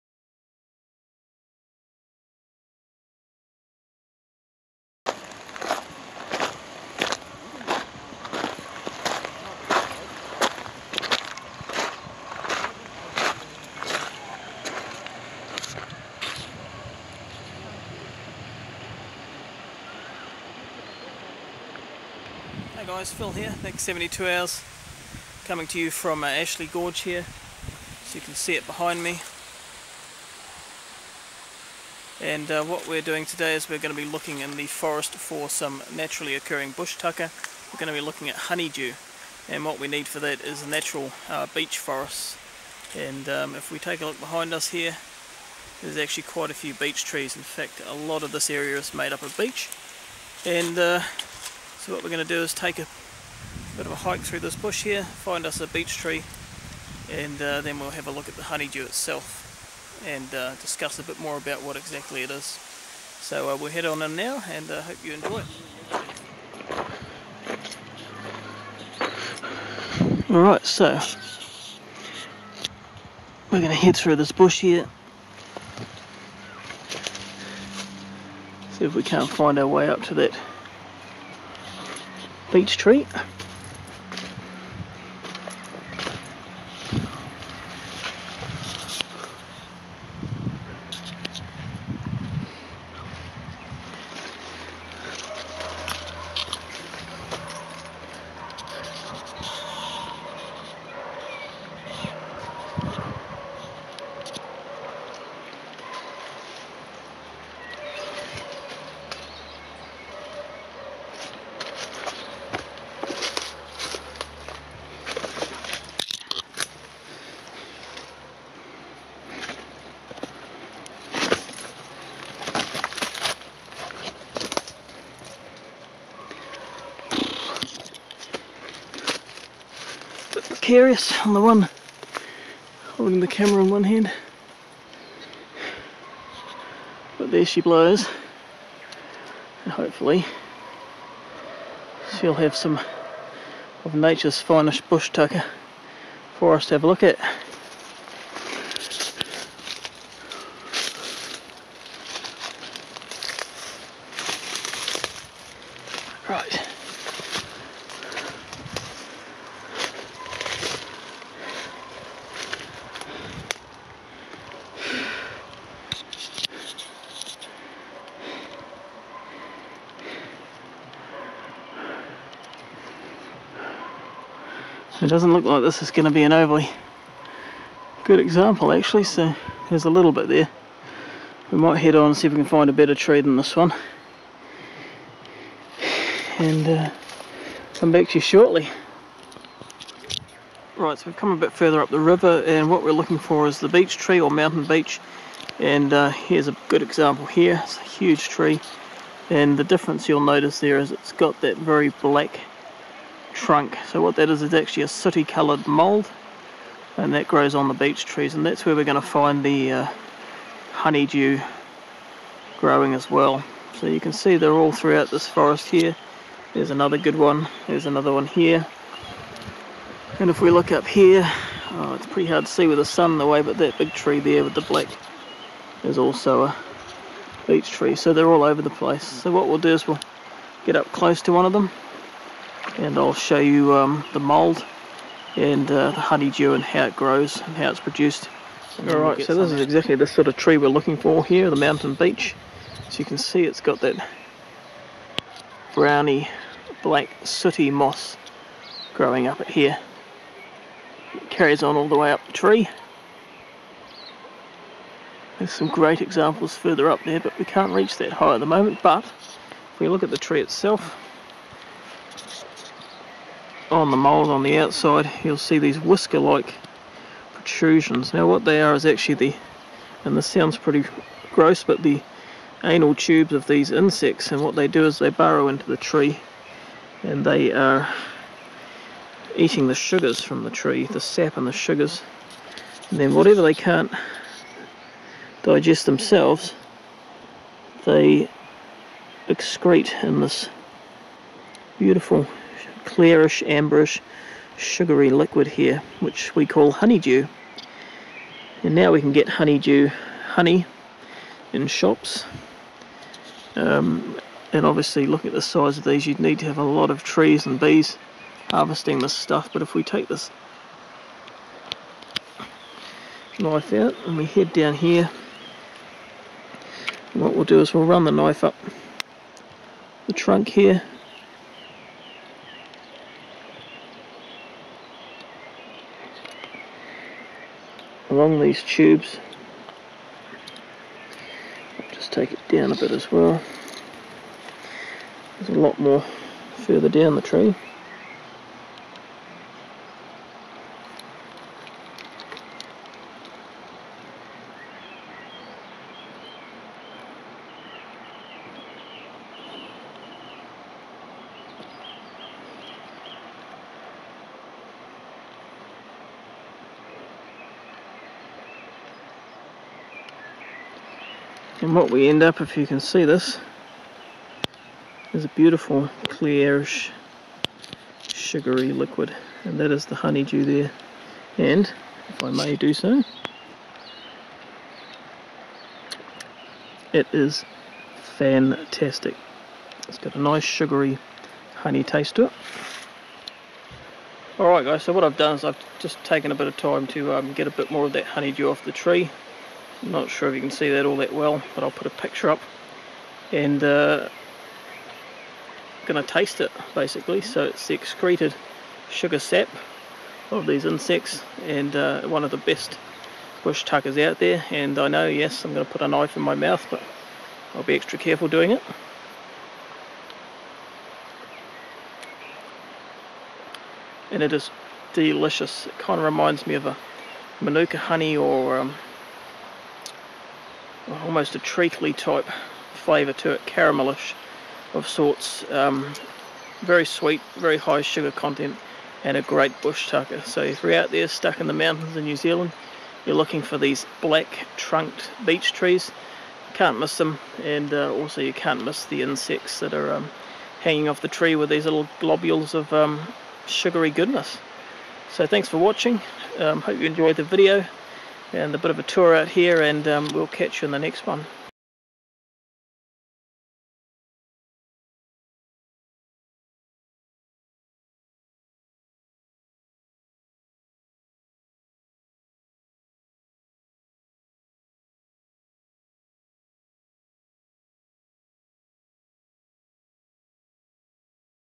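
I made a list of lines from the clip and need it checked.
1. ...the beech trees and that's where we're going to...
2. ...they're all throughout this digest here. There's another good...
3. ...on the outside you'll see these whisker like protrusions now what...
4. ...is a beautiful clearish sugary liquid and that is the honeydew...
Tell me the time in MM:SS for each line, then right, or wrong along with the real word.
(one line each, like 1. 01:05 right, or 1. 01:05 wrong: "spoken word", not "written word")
1. 03:27 right
2. 03:34 wrong: "forest", not "digest"
3. 04:24 right
4. 06:05 right.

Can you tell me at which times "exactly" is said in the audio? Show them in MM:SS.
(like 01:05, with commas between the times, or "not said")
01:01, 03:59.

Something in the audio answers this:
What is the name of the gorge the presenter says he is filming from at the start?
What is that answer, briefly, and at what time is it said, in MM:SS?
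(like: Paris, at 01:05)
Ashley Gorge, at 00:26.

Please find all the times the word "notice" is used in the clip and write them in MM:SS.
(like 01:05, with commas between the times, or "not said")
03:20.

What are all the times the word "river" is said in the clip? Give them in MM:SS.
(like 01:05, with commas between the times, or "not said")
03:11.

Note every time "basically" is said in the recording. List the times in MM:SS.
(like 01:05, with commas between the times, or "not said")
06:36.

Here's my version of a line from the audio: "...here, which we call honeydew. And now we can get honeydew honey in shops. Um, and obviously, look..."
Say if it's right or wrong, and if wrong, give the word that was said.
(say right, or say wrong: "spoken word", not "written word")
right.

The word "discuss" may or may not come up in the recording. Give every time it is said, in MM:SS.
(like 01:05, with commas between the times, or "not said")
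01:00.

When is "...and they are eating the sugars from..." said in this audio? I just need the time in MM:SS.
04:37.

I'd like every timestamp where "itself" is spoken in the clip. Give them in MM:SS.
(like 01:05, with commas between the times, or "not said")
00:58, 04:20.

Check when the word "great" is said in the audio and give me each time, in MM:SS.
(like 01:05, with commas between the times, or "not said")
04:15, 07:09.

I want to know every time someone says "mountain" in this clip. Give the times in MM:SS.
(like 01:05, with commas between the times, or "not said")
03:14, 04:01, 07:11.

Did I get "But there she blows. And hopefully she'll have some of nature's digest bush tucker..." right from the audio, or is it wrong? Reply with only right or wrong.
wrong.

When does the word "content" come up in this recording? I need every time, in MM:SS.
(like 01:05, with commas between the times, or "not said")
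07:08.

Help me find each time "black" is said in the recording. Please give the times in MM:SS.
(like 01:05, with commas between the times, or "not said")
03:22, 03:44, 04:06, 07:13.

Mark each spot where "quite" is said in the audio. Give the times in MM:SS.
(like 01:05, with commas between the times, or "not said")
00:46.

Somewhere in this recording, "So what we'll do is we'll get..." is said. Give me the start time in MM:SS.
03:49.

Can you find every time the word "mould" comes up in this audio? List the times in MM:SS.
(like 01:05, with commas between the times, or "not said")
03:25, 03:54.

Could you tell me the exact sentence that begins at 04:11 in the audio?
It carries on all the way up the tree.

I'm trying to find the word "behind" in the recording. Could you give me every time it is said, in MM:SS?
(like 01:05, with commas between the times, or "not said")
00:28, 00:44.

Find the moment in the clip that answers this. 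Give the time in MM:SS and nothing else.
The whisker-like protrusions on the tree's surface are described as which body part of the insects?
04:32.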